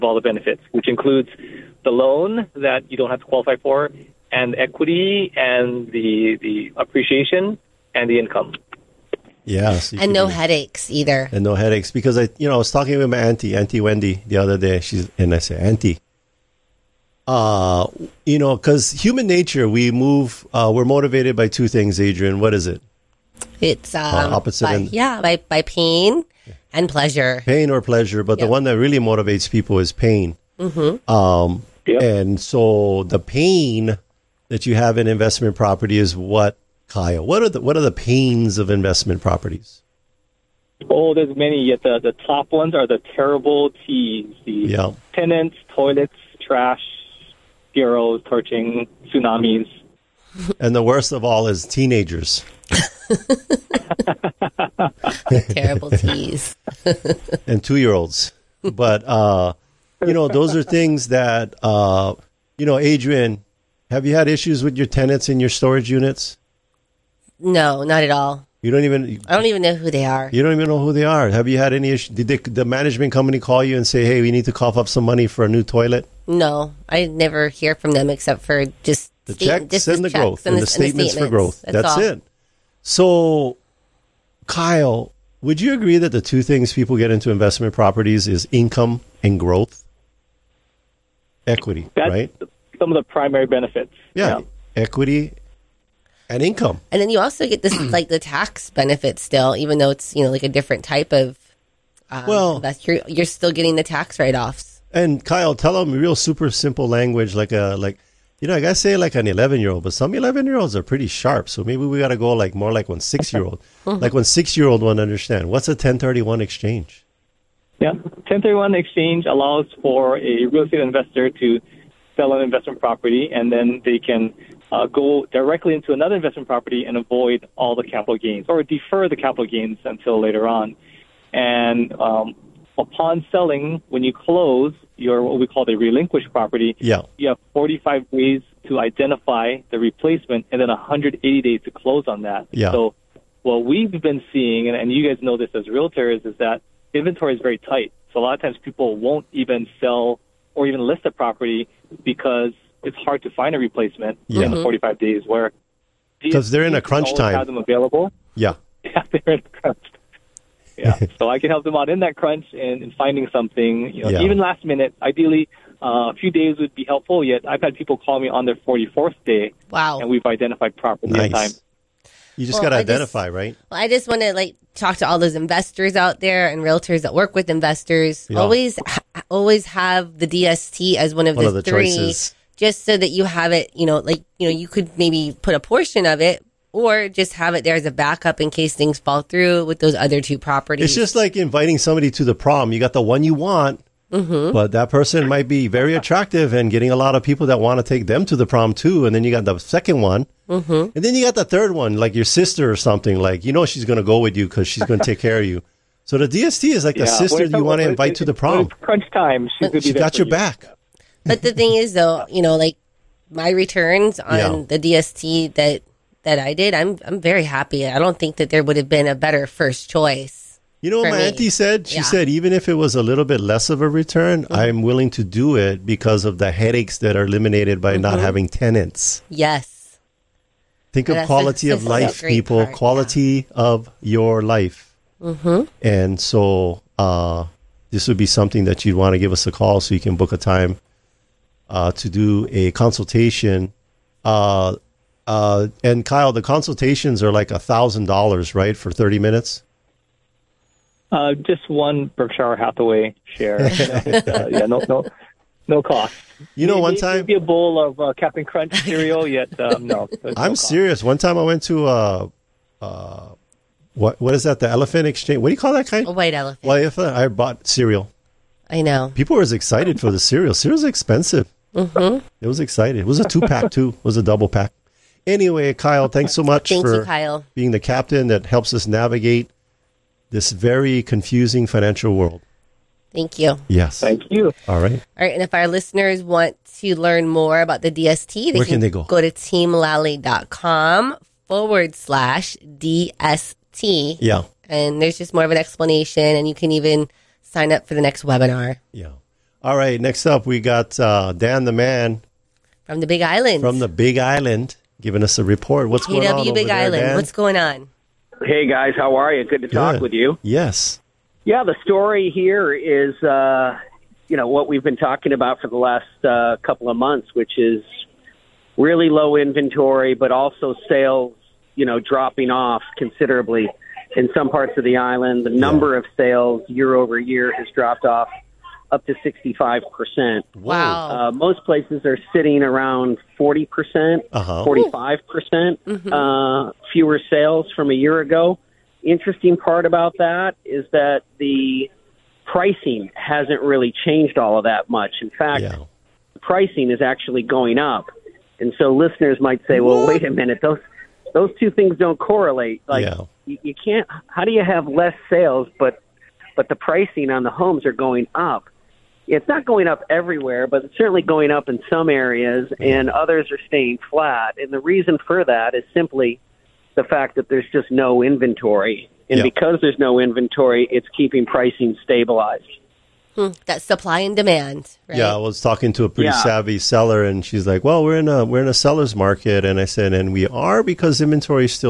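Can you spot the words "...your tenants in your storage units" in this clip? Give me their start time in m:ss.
1:04.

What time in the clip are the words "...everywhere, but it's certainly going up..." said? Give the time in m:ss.
6:00.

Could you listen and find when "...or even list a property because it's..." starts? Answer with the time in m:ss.
2:30.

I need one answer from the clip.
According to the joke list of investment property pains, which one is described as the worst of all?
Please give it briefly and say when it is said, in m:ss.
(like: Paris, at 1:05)
Teenagers, at 0:51.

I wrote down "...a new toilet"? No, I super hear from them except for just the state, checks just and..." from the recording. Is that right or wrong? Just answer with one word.
wrong.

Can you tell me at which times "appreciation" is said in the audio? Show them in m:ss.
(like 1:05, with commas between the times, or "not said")
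0:06.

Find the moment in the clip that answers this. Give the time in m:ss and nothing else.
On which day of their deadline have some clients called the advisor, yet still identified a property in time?
2:48.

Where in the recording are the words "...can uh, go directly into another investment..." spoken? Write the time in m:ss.
2:03.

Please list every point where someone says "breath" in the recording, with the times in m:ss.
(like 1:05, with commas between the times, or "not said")
not said.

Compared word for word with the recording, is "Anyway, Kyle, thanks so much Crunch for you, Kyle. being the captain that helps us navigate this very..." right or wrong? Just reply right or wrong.
wrong.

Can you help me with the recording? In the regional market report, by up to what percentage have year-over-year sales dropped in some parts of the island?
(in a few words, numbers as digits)
65%.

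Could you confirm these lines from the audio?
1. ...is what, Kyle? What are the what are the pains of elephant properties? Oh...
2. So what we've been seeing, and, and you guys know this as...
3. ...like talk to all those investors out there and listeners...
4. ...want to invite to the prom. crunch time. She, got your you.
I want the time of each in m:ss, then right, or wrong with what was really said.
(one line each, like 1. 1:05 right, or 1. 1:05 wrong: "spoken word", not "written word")
1. 0:35 wrong: "investment", not "elephant"
2. 2:22 right
3. 2:54 wrong: "realtors", not "listeners"
4. 3:27 right.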